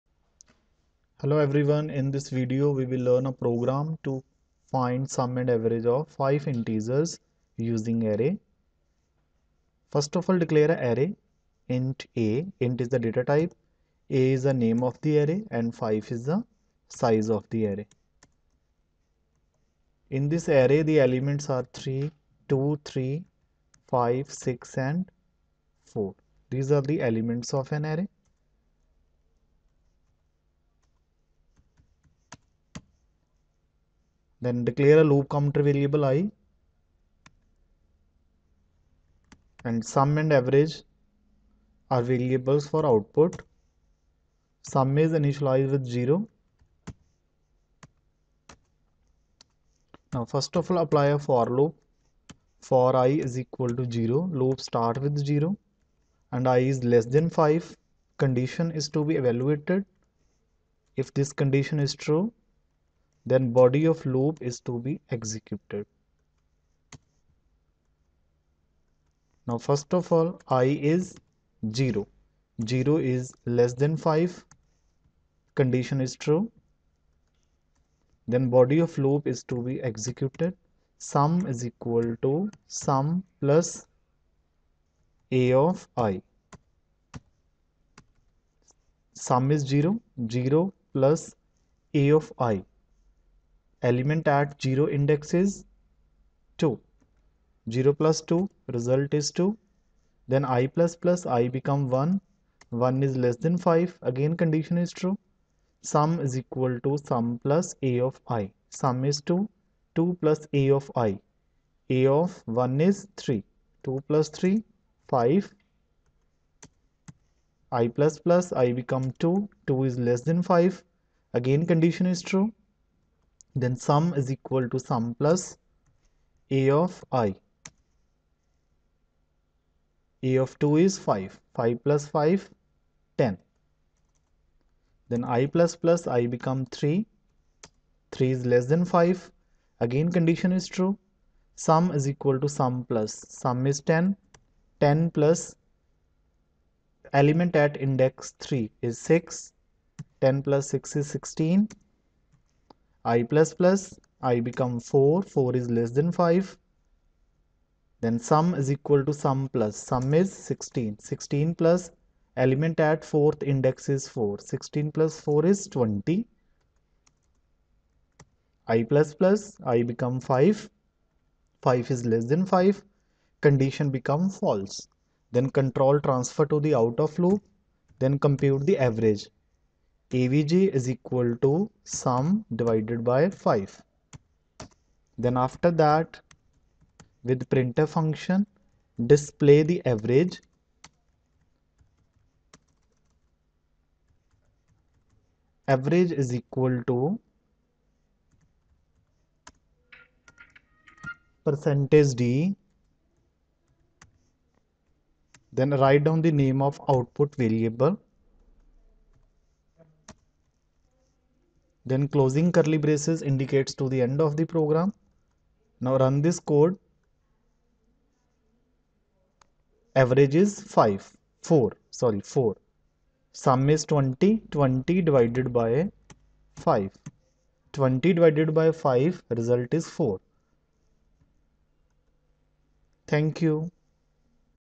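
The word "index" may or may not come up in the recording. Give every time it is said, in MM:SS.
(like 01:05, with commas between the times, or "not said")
01:34, 02:27, 02:43.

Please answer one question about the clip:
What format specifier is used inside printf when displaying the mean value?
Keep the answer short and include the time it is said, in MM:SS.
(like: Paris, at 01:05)
%d, at 03:21.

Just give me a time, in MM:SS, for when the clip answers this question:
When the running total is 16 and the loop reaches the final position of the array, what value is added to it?
02:40.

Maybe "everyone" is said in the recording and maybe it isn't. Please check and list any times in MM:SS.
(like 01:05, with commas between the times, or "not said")
00:01.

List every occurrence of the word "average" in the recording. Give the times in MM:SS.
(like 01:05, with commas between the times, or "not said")
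00:05, 00:40, 02:58, 03:09, 03:15, 03:39.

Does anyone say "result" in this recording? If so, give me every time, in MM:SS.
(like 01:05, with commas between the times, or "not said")
01:38, 03:49.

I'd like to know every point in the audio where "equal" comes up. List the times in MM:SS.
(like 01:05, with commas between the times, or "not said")
00:53, 01:21, 01:46, 02:04, 02:22, 02:38, 03:00, 03:16.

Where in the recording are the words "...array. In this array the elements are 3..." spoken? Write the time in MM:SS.
00:17.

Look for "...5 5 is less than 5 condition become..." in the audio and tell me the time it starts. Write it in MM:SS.
02:50.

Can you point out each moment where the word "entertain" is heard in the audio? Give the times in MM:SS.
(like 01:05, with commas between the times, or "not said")
not said.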